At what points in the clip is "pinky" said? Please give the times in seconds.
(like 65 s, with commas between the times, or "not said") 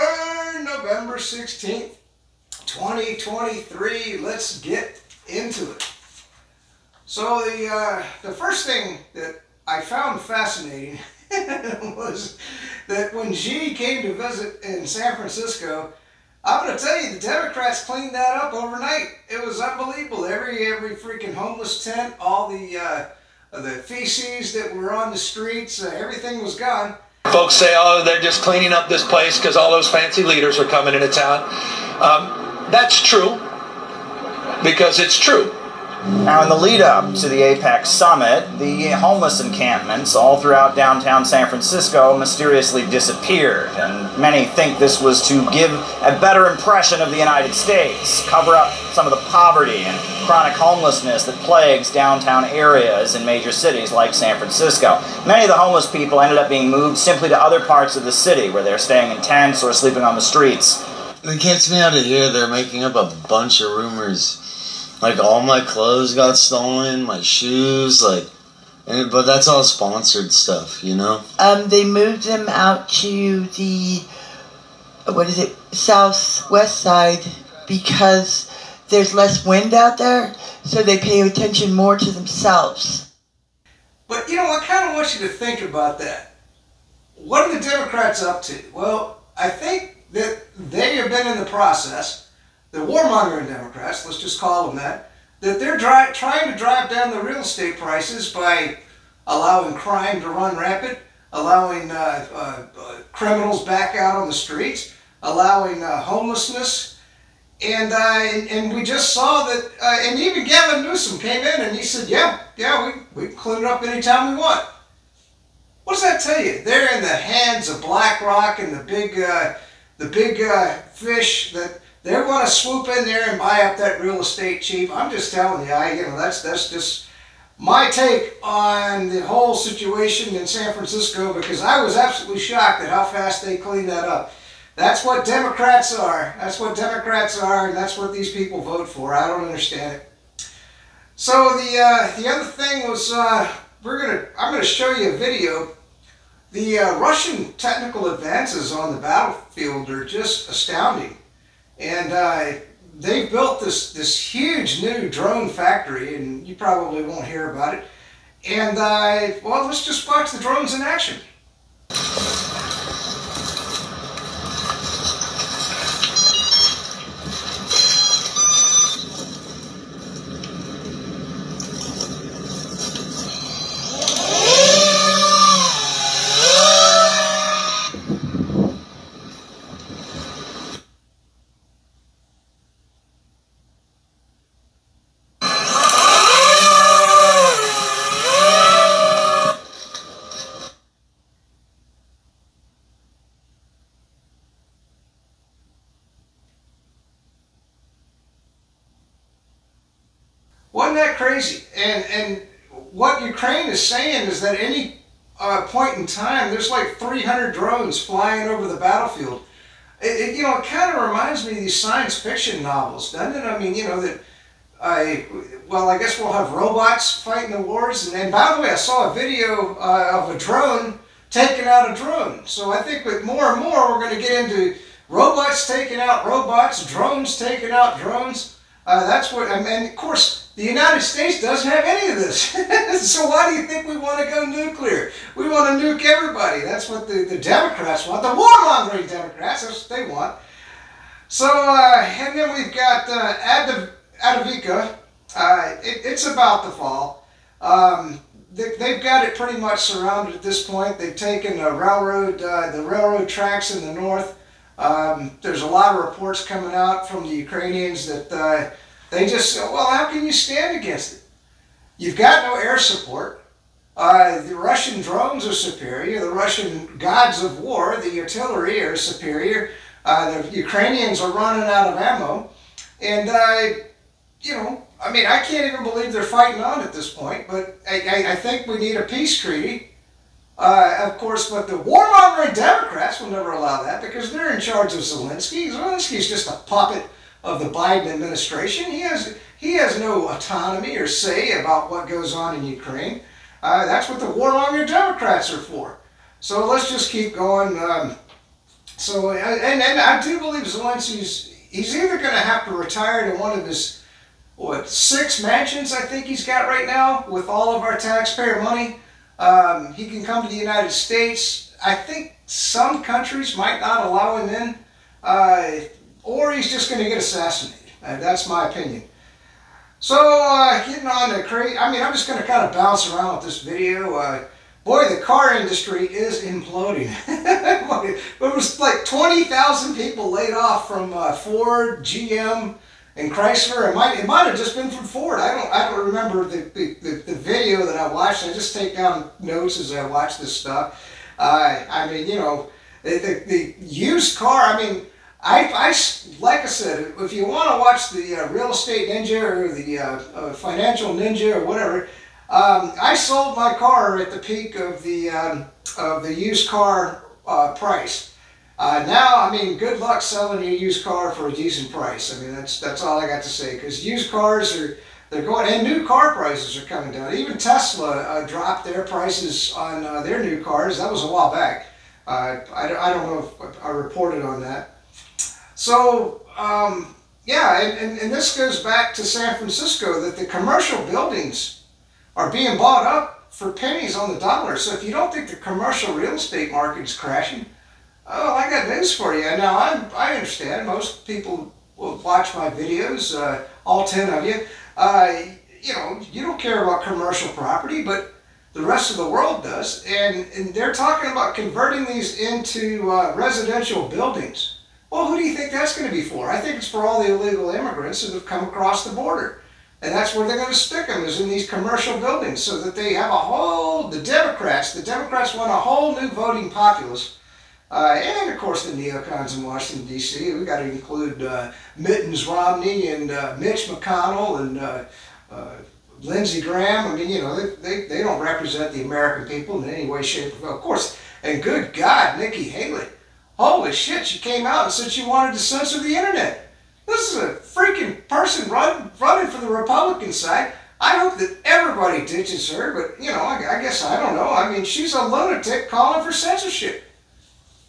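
not said.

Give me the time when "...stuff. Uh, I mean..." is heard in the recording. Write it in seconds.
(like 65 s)
340 s.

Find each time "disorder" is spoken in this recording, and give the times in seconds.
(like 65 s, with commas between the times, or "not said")
not said.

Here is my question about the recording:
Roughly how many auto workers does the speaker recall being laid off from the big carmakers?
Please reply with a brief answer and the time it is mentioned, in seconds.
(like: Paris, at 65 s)
20,000, at 329 s.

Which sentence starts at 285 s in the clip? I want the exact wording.
Zelensky's just a puppet of the Biden administration.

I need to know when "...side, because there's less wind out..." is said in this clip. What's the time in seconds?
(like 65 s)
76 s.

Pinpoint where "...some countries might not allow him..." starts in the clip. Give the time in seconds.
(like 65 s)
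312 s.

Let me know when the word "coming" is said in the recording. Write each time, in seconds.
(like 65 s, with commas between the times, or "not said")
30 s, 256 s, 366 s.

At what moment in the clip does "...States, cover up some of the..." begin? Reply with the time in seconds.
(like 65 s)
47 s.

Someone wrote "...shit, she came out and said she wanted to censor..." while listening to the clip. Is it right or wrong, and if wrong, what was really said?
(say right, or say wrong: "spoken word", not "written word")
right.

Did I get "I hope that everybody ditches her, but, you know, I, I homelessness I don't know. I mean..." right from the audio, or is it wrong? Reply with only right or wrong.
wrong.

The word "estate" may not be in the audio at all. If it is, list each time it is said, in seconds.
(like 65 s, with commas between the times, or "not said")
97 s, 124 s, 348 s, 386 s.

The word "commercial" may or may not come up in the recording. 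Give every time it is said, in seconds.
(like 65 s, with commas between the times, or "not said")
380 s, 385 s, 397 s, 411 s.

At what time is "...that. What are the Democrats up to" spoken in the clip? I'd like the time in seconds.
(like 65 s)
85 s.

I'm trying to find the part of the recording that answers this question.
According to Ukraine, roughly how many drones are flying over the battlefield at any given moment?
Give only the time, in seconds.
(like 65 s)
206 s.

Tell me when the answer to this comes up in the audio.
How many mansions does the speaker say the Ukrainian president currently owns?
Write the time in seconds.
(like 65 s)
304 s.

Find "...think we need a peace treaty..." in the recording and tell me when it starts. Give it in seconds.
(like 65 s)
278 s.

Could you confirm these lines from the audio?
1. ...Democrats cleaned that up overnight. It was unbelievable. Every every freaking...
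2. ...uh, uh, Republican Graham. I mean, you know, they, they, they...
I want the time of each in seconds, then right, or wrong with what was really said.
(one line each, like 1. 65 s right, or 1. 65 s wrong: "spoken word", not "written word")
1. 17 s right
2. 424 s wrong: "Lindsey", not "Republican".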